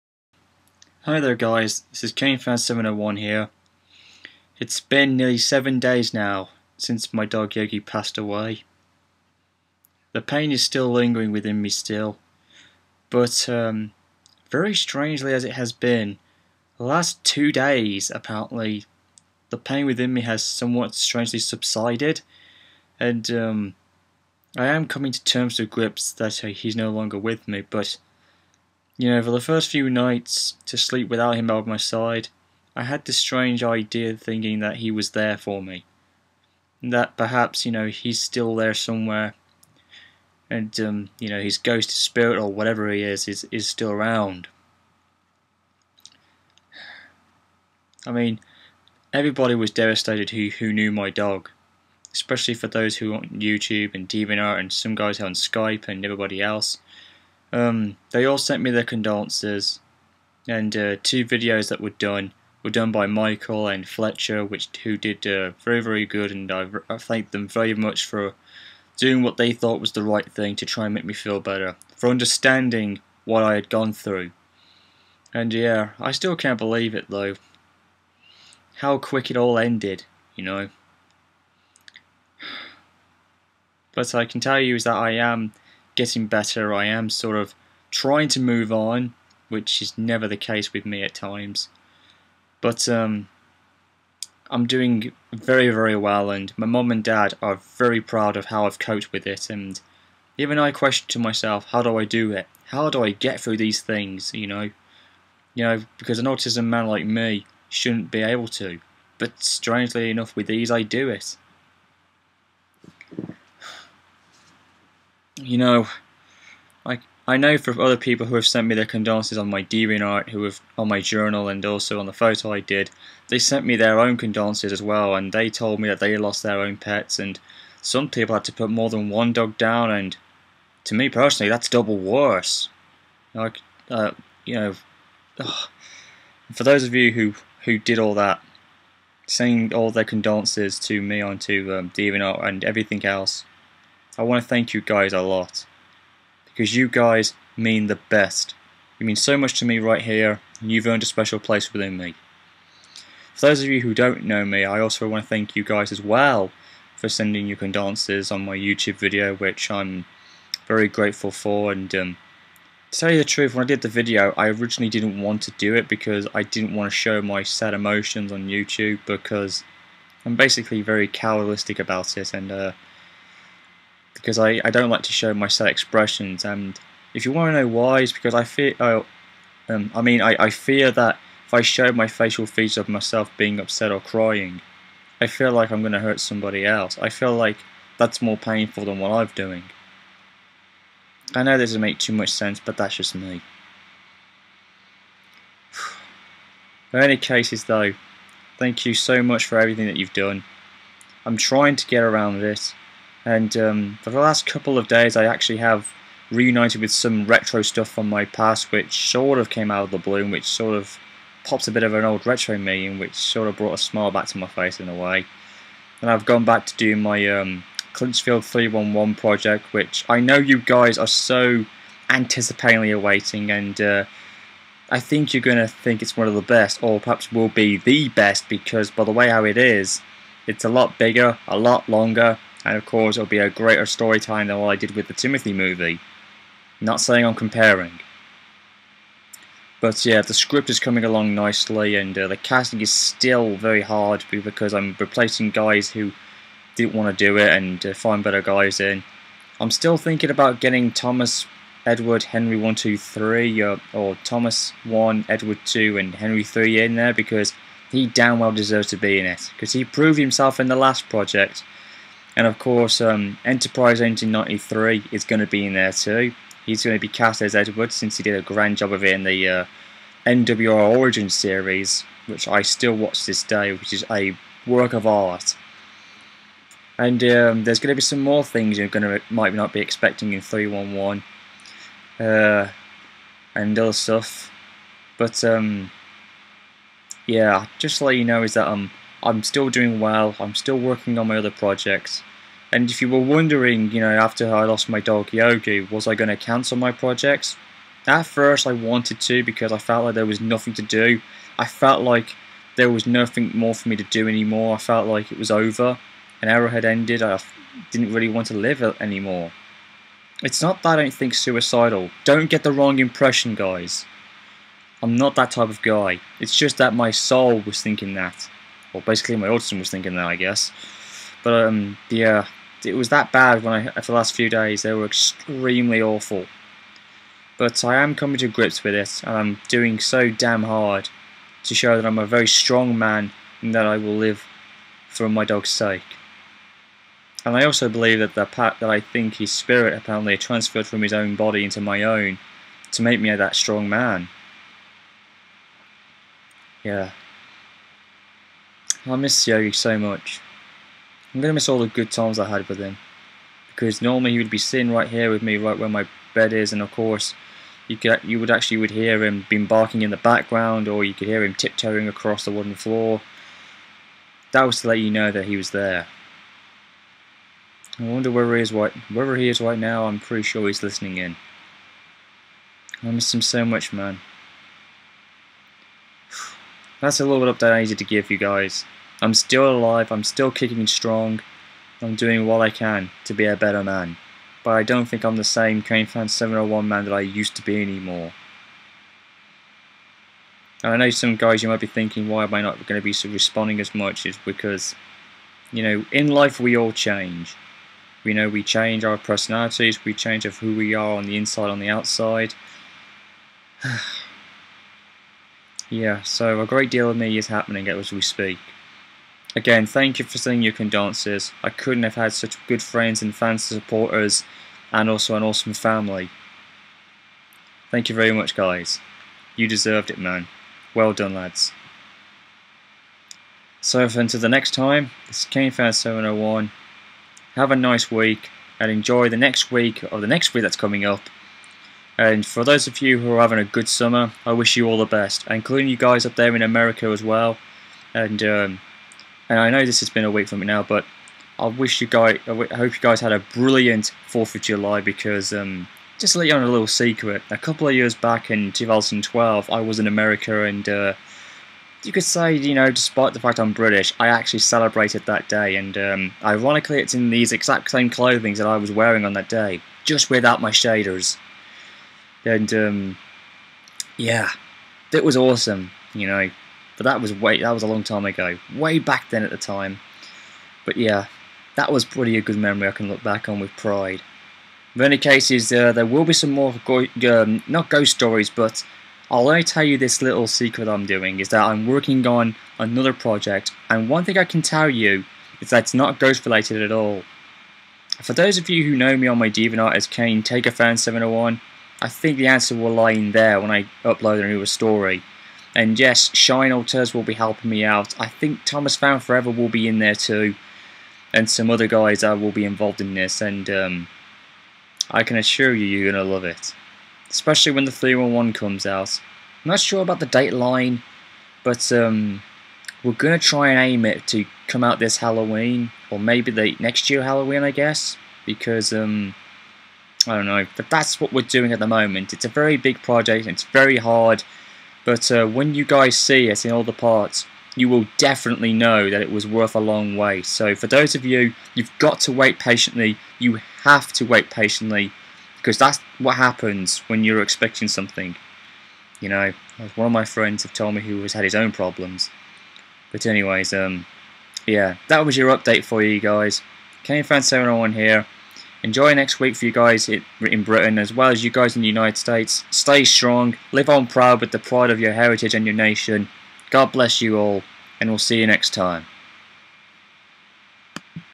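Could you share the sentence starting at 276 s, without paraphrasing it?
And um, there's going to be some more things you're going to might not be expecting in 311, uh, and other stuff.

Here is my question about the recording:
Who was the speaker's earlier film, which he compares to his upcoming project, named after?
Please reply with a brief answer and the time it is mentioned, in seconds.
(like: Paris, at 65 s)
Timothy, at 235 s.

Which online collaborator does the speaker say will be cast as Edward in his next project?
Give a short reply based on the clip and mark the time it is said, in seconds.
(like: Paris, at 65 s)
Enterprise 1993, at 263 s.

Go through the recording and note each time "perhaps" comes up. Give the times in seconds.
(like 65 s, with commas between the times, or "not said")
37 s, 226 s.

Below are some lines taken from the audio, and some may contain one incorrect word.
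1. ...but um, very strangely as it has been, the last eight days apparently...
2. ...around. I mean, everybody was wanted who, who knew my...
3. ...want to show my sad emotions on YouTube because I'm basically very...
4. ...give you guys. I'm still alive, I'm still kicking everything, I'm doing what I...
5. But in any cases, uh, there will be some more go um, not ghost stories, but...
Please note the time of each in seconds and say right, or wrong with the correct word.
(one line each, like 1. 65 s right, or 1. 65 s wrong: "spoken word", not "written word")
1. 13 s wrong: "two", not "eight"
2. 43 s wrong: "devastated", not "wanted"
3. 166 s right
4. 378 s wrong: "strong", not "everything"
5. 474 s right.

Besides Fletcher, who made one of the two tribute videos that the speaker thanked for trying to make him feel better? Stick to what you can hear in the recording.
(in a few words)
Michael.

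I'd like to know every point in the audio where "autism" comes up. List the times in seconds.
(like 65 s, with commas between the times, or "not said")
106 s, 319 s.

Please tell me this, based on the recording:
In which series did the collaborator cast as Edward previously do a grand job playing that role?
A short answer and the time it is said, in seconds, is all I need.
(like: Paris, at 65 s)
NWR Origin series, at 270 s.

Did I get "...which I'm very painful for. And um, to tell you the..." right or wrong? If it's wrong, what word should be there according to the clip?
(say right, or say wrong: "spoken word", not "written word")
wrong: "grateful", not "painful".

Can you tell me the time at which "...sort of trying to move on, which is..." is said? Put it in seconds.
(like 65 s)
87 s.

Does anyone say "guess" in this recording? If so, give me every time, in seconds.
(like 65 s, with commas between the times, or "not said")
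320 s, 517 s.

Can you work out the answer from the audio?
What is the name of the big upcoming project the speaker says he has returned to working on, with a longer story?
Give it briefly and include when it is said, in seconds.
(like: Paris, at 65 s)
Clinchfield 311, at 217 s.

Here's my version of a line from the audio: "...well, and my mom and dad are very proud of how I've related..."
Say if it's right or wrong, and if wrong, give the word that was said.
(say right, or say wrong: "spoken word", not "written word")
wrong: "coped", not "related".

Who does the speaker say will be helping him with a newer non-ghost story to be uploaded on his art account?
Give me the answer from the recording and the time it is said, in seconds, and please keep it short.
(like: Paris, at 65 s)
Shine Alters, at 496 s.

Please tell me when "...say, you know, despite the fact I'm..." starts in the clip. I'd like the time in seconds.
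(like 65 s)
452 s.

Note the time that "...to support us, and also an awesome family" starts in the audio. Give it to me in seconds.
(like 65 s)
413 s.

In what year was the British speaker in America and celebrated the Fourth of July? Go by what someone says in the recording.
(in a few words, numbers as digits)
2012.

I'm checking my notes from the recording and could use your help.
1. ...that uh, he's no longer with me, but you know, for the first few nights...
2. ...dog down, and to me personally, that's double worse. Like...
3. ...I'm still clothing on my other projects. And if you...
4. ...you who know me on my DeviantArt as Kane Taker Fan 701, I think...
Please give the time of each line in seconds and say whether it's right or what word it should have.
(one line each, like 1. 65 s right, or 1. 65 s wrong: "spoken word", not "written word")
1. 26 s right
2. 129 s right
3. 290 s wrong: "working", not "clothing"
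4. 488 s right.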